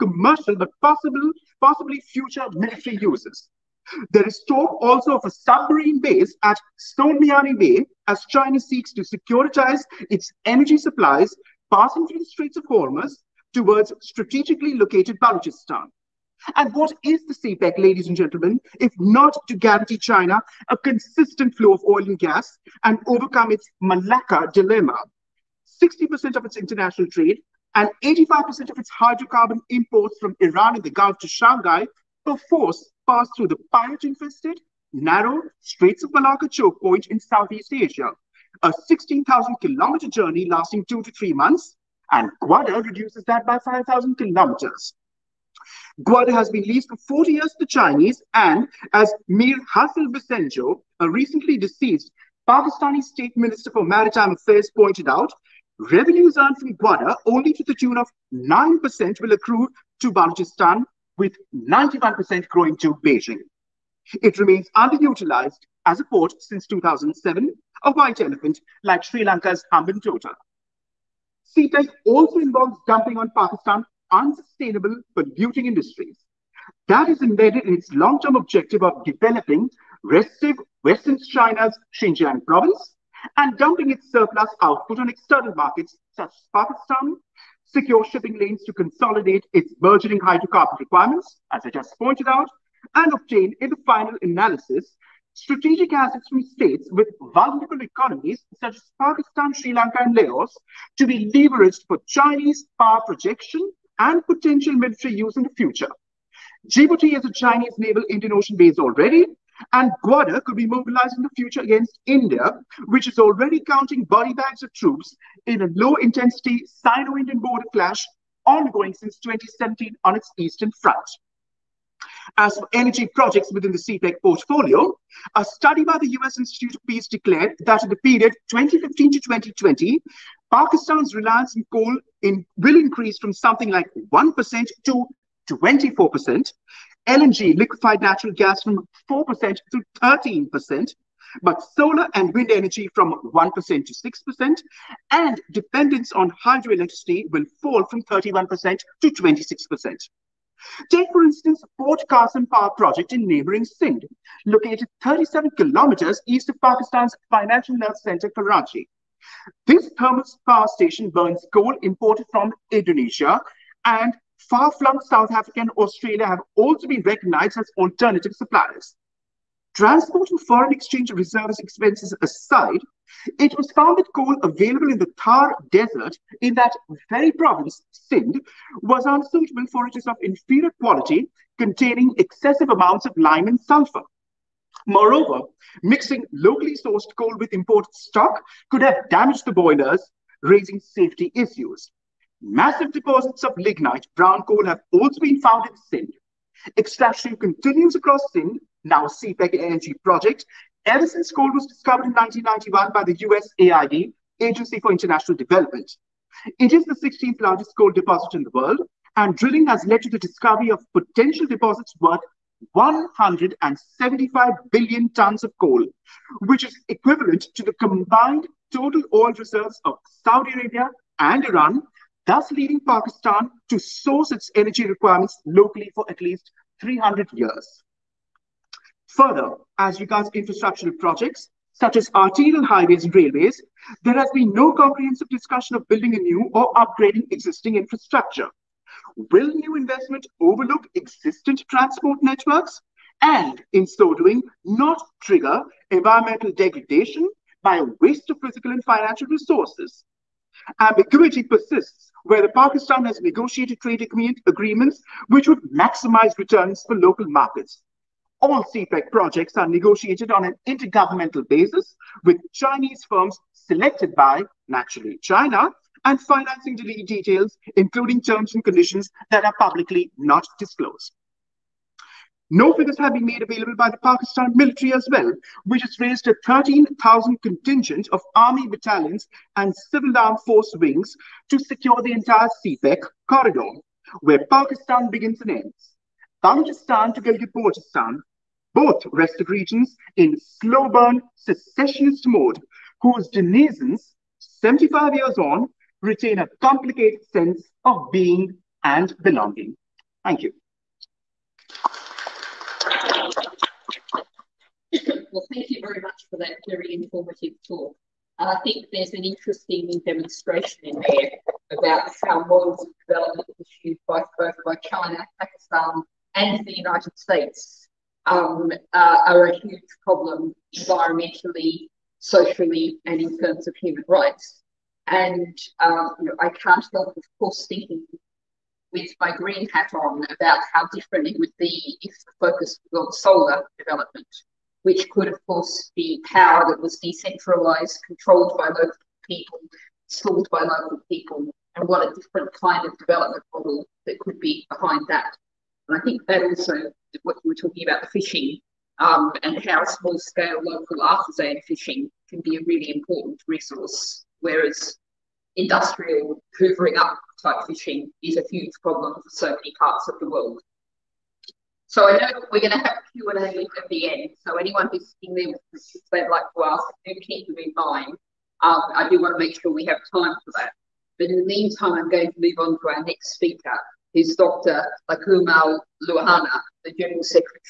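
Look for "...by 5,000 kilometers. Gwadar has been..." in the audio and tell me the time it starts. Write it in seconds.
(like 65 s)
43 s.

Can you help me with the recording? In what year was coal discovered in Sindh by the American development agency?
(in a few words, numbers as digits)
1991.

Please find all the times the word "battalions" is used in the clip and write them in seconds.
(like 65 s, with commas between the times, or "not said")
278 s.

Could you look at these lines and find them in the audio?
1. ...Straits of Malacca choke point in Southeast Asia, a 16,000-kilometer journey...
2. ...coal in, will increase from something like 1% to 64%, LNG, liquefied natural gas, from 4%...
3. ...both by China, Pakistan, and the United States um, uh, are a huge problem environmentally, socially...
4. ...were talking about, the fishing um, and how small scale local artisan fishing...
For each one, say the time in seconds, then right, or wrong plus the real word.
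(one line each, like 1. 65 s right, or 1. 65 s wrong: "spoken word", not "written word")
1. 35 s right
2. 131 s wrong: "24", not "64"
3. 314 s right
4. 347 s right.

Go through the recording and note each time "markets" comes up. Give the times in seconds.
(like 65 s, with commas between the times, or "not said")
85 s, 257 s.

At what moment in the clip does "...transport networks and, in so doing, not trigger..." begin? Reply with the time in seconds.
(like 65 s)
241 s.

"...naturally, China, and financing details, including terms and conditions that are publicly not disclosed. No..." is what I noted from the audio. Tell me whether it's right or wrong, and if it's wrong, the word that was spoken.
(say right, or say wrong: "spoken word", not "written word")
right.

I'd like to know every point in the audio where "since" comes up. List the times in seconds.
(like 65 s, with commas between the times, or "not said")
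66 s, 118 s, 201 s.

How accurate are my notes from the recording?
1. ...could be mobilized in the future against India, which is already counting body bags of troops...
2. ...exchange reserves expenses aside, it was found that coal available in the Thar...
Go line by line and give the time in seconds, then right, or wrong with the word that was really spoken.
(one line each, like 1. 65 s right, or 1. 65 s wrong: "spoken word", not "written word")
1. 110 s right
2. 170 s right.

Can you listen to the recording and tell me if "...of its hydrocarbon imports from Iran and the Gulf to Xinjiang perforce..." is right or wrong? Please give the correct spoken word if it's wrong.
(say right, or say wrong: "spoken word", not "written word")
wrong: "Shanghai", not "Xinjiang".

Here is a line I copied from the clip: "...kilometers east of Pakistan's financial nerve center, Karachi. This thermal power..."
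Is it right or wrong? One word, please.
right.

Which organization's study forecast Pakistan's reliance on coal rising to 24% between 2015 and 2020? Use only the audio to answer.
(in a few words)
US Institute of Peace.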